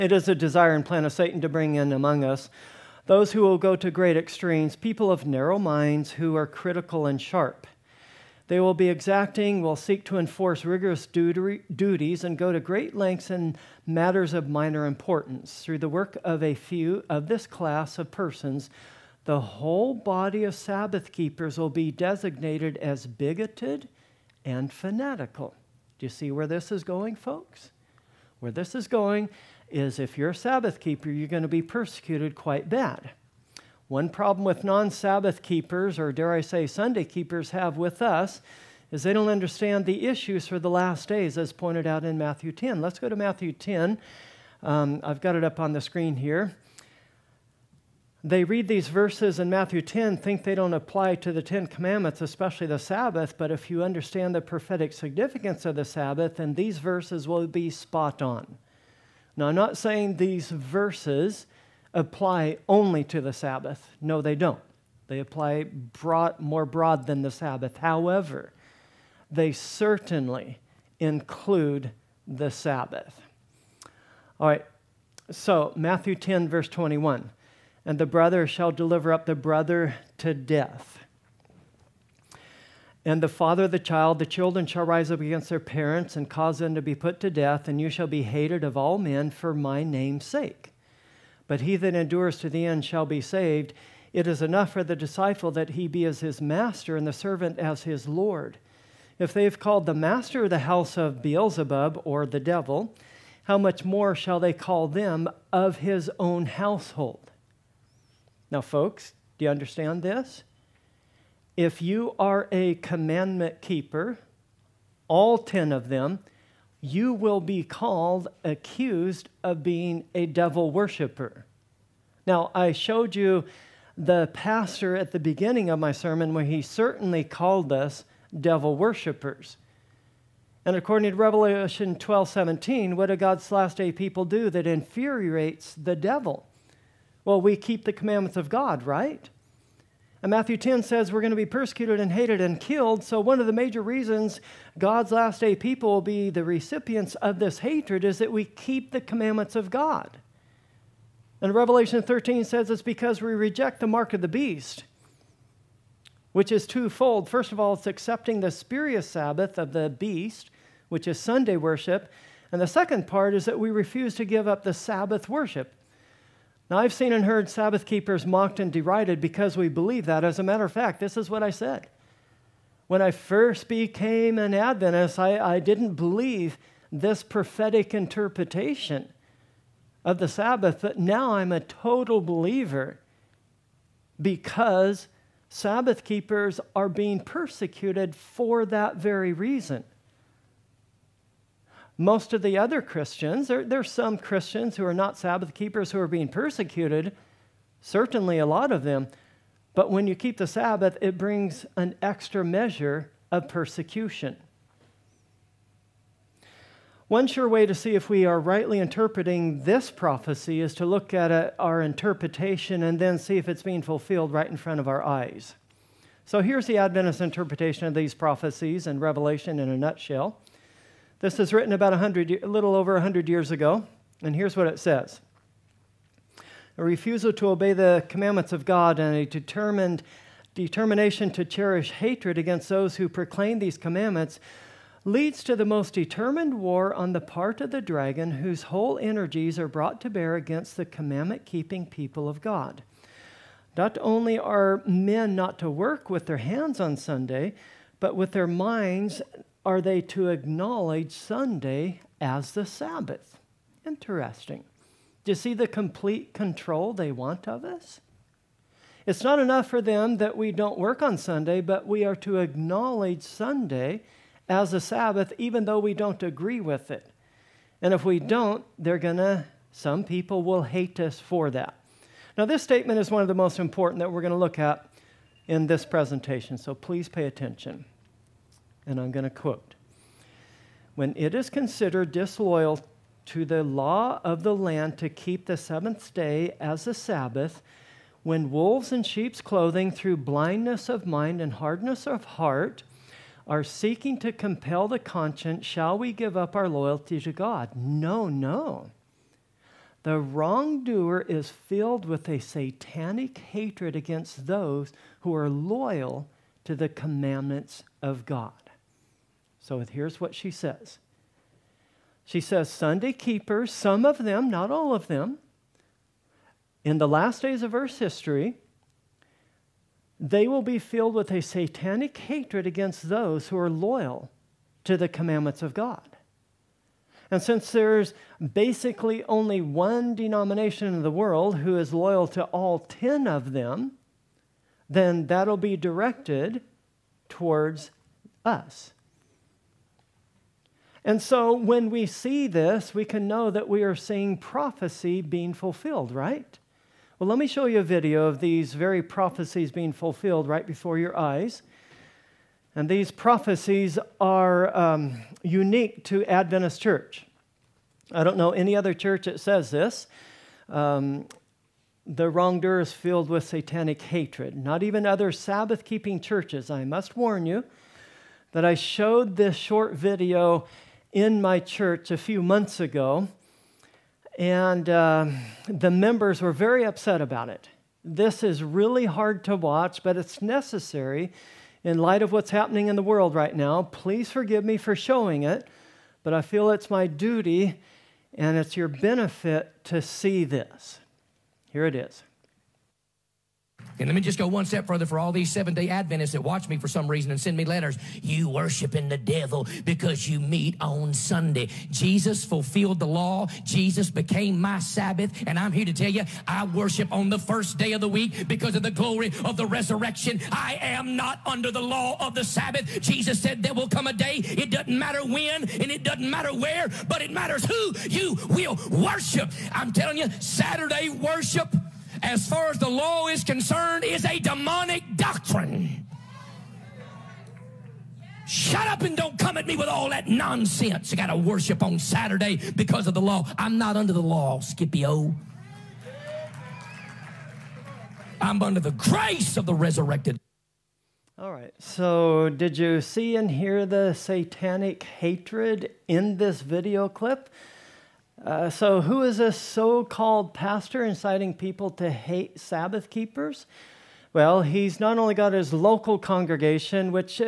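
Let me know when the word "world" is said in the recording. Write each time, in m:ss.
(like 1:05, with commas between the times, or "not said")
5:31, 6:23.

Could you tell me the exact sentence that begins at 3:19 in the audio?
But when you keep the Sabbath, it brings an extra measure of persecution.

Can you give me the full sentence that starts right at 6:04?
Not even other Sabbath keeping churches.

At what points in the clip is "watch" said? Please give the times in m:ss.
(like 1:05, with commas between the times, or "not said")
6:19, 6:36.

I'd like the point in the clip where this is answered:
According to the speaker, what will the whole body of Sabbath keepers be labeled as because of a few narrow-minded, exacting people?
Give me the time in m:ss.
0:23.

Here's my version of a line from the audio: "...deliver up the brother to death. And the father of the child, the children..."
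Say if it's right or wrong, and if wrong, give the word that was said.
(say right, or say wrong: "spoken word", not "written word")
right.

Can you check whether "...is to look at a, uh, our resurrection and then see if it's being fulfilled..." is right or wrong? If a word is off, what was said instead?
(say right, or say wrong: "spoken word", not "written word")
wrong: "interpretation", not "resurrection".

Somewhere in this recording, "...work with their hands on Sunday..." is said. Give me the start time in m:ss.
4:05.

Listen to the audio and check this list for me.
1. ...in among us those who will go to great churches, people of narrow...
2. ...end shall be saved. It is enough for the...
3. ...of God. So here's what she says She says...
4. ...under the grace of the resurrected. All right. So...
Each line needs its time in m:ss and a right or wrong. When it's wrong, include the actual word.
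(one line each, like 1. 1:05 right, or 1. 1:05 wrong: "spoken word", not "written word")
1. 0:01 wrong: "extremes", not "churches"
2. 1:32 right
3. 5:08 right
4. 7:18 right.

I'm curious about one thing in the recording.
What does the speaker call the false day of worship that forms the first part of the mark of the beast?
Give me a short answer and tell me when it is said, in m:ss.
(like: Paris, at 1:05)
Spurious Sabbath, at 2:38.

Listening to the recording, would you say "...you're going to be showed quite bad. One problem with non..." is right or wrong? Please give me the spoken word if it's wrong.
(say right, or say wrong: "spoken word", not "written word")
wrong: "persecuted", not "showed".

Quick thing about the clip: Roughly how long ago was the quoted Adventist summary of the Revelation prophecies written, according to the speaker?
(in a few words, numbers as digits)
A little over 100 years.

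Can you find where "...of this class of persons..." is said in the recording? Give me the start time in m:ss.
0:17.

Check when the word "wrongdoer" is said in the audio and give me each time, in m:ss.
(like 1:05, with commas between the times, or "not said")
5:00, 6:02.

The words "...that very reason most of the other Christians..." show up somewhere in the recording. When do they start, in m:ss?
3:08.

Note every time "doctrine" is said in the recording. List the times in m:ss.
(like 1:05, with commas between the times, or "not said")
7:05.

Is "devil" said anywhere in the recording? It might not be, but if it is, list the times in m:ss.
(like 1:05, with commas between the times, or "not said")
1:42, 2:00, 2:08, 2:15, 6:39.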